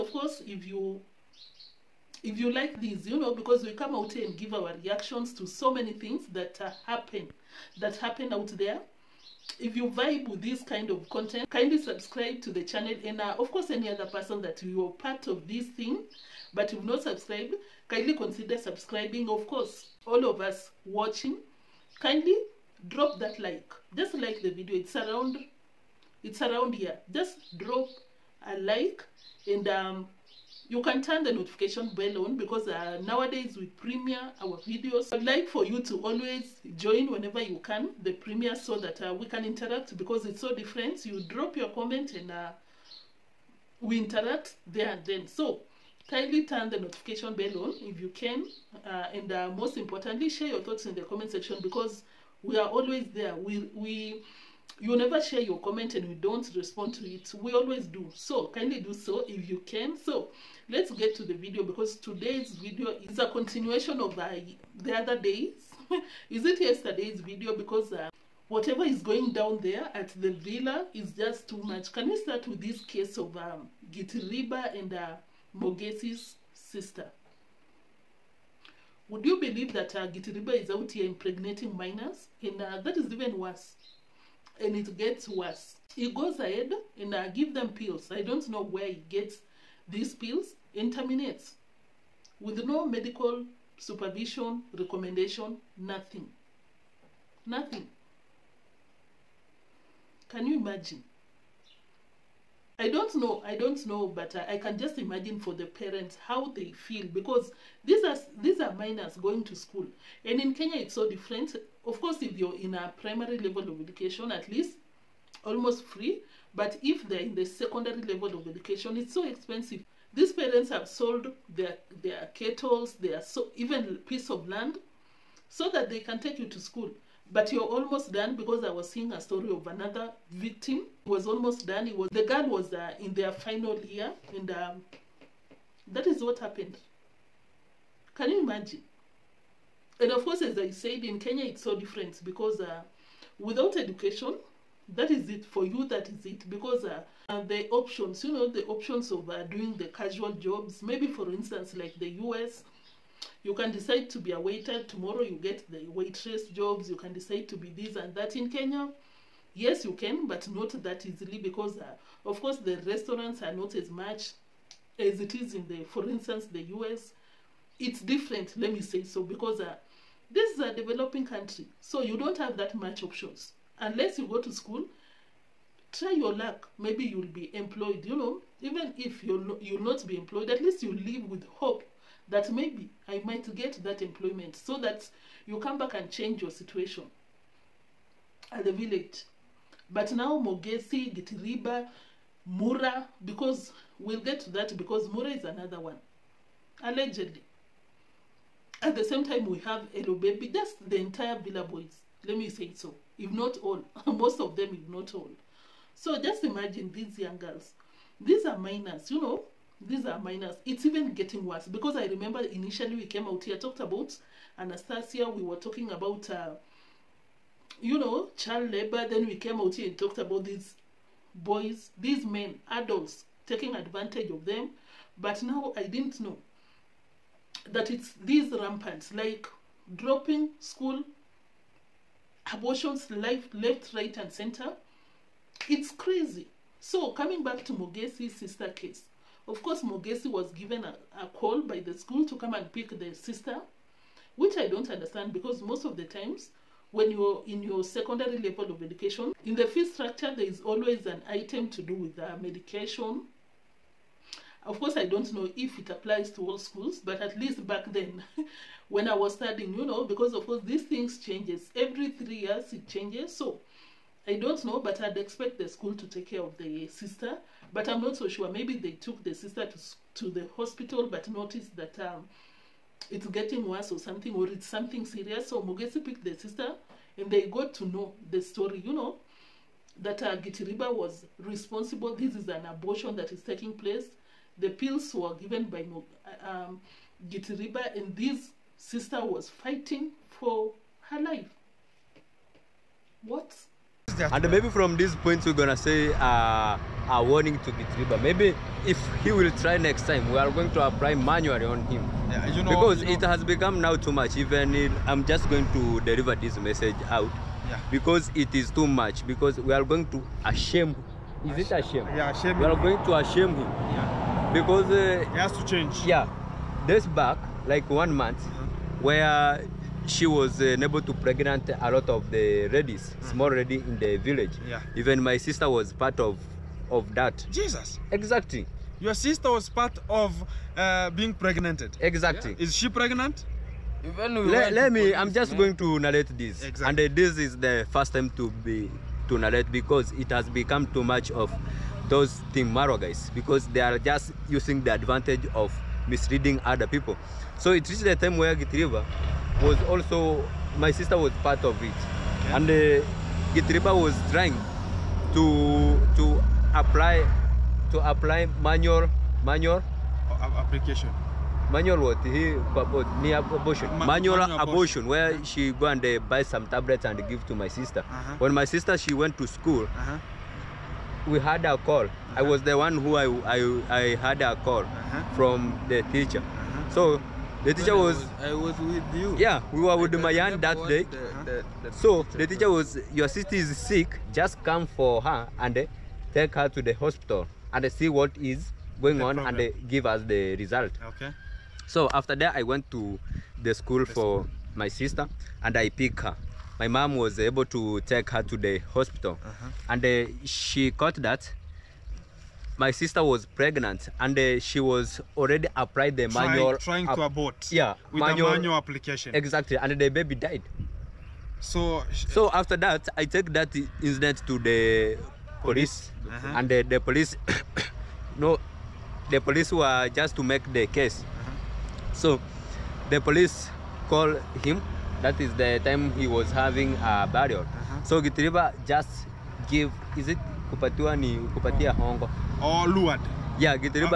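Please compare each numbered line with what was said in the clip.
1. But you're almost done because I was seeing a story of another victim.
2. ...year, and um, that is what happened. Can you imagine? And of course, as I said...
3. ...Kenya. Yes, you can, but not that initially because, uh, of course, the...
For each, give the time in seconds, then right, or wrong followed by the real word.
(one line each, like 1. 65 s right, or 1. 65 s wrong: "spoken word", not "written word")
1. 127 s right
2. 133 s right
3. 158 s wrong: "easily", not "initially".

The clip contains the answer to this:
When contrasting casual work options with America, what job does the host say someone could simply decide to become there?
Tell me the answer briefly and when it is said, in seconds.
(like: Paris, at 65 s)
A waiter, at 154 s.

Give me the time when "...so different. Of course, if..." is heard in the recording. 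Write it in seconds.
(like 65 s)
110 s.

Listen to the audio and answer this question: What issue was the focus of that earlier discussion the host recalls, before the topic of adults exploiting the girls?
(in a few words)
Child labor.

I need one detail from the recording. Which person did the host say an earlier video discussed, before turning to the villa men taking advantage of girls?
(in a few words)
Anastasia.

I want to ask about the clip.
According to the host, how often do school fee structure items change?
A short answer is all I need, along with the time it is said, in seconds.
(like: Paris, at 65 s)
Every three years, at 261 s.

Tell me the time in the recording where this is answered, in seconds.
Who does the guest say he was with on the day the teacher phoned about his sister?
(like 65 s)
380 s.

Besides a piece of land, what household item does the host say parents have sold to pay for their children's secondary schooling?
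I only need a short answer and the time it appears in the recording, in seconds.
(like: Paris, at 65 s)
Kettles, at 122 s.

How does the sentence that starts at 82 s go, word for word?
And uh, that is even worse and it gets worse.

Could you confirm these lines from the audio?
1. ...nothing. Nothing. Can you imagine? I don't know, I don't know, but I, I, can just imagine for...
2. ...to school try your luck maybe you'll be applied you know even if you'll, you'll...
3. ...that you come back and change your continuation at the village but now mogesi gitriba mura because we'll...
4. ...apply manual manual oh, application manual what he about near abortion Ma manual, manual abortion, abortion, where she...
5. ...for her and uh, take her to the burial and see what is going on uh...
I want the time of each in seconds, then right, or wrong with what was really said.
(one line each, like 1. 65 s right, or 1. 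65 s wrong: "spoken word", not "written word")
1. 95 s right
2. 174 s wrong: "employed", not "applied"
3. 184 s wrong: "situation", not "continuation"
4. 358 s right
5. 384 s wrong: "hospital", not "burial".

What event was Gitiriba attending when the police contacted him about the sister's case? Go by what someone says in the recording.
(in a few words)
A burial.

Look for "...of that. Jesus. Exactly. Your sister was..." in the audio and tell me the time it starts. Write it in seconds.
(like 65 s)
326 s.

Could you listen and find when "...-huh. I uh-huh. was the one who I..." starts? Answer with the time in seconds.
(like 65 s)
372 s.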